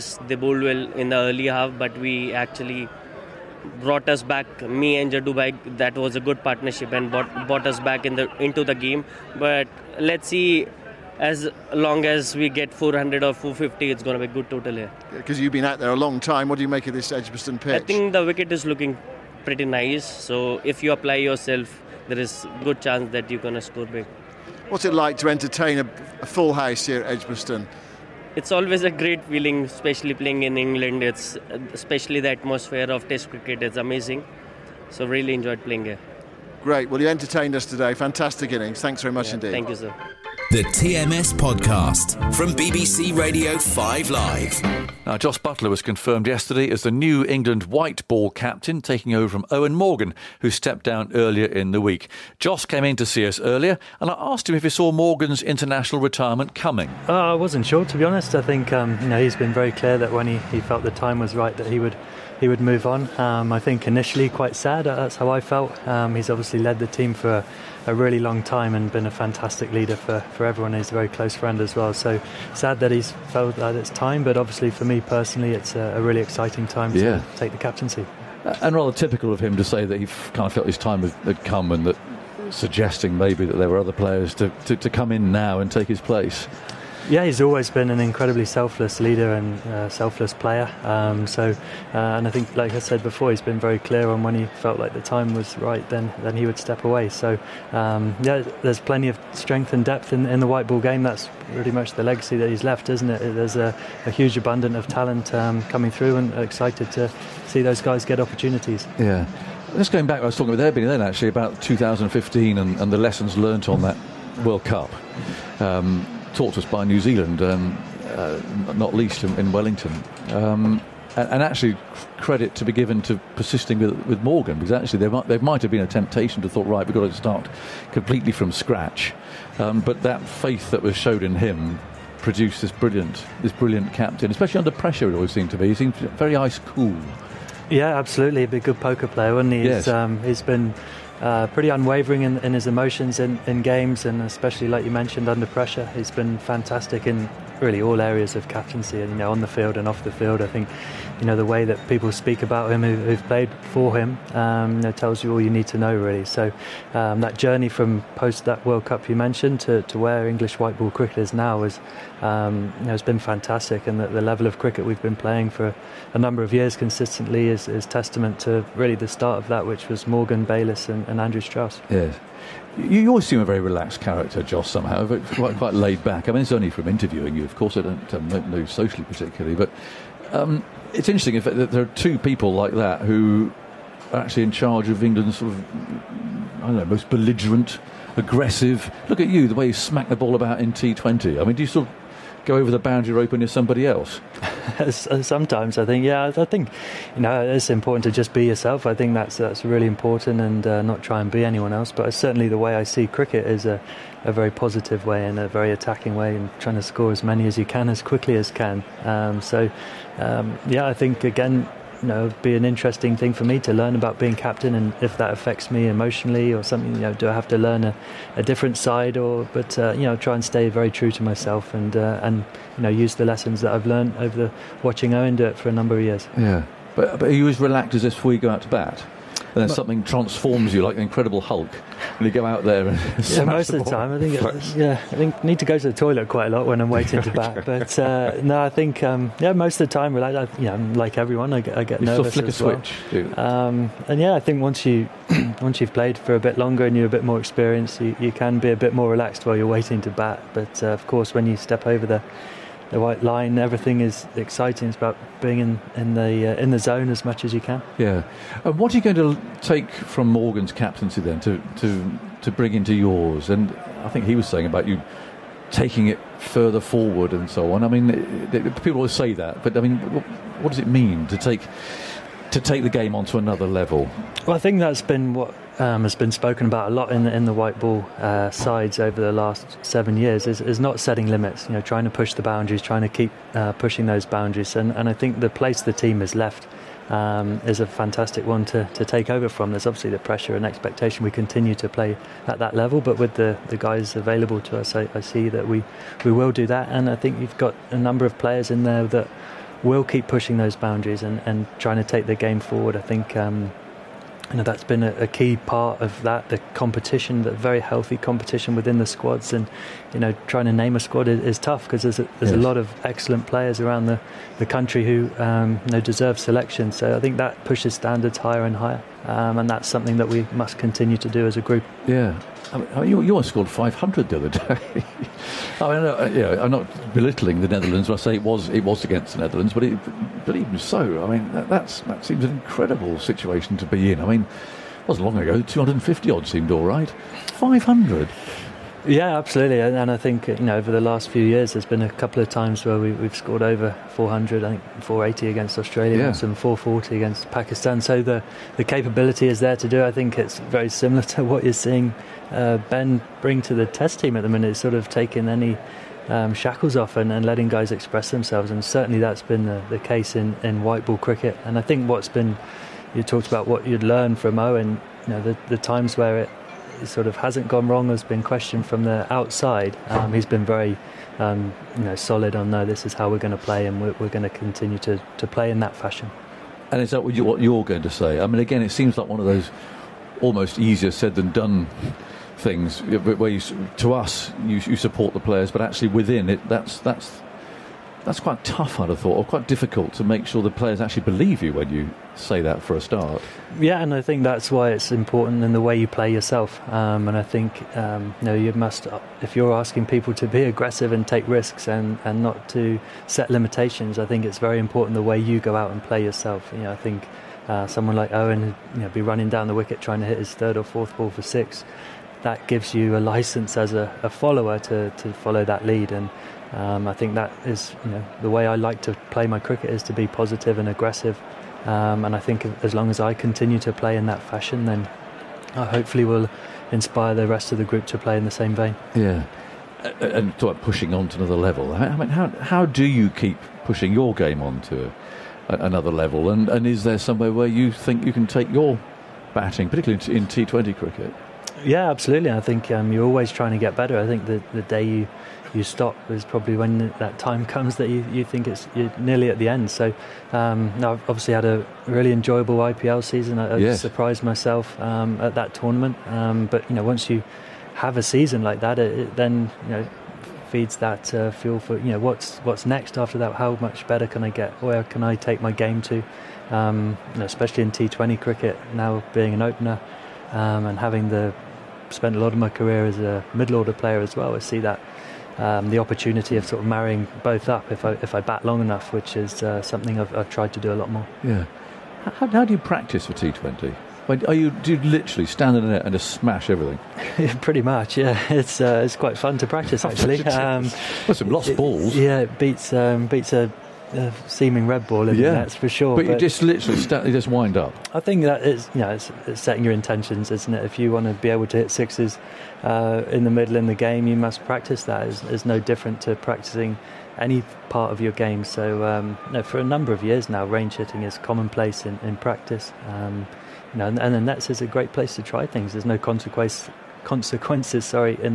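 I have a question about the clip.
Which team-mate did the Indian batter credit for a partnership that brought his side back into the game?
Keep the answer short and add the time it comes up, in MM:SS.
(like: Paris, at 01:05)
Jaddu Bhai, at 00:05.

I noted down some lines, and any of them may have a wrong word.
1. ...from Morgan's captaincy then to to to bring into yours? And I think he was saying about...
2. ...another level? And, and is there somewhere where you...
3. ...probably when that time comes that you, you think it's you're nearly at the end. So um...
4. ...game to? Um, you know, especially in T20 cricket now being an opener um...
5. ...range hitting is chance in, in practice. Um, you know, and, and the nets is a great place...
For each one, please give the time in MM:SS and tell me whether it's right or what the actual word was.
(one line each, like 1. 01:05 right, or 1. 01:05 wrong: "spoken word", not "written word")
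1. 04:19 right
2. 07:15 right
3. 07:26 right
4. 07:45 right
5. 08:30 wrong: "commonplace", not "chance".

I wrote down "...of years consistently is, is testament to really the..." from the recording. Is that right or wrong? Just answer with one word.
right.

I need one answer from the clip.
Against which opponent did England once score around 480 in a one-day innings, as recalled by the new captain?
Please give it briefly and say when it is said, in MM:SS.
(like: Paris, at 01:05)
Australia, at 05:45.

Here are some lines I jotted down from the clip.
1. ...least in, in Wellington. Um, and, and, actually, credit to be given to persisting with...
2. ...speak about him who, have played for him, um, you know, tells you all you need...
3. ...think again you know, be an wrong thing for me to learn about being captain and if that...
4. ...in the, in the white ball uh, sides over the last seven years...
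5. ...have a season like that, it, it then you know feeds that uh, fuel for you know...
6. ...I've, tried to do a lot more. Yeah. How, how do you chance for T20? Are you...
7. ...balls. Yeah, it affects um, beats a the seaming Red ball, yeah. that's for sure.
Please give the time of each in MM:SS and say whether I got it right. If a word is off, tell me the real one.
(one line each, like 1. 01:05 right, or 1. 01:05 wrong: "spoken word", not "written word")
1. 01:58 right
2. 02:32 right
3. 03:30 wrong: "interesting", not "wrong"
4. 04:37 right
5. 07:37 right
6. 08:00 wrong: "practice", not "chance"
7. 08:11 wrong: "beats", not "affects".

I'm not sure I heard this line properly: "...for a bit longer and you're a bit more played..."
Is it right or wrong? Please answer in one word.
wrong.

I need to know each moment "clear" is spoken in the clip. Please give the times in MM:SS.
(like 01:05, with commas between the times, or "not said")
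00:59, 01:33.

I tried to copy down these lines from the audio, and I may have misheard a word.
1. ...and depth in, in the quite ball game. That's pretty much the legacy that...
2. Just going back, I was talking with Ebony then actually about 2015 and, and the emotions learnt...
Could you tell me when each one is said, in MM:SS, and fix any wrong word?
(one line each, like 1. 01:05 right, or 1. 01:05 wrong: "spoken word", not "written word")
1. 01:39 wrong: "white", not "quite"
2. 01:49 wrong: "lessons", not "emotions".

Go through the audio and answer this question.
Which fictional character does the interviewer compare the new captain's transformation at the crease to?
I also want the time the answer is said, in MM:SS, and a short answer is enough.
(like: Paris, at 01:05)
The Incredible Hulk, at 03:51.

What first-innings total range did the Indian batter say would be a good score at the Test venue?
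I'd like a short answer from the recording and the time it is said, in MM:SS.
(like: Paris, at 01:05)
400 or 450, at 00:12.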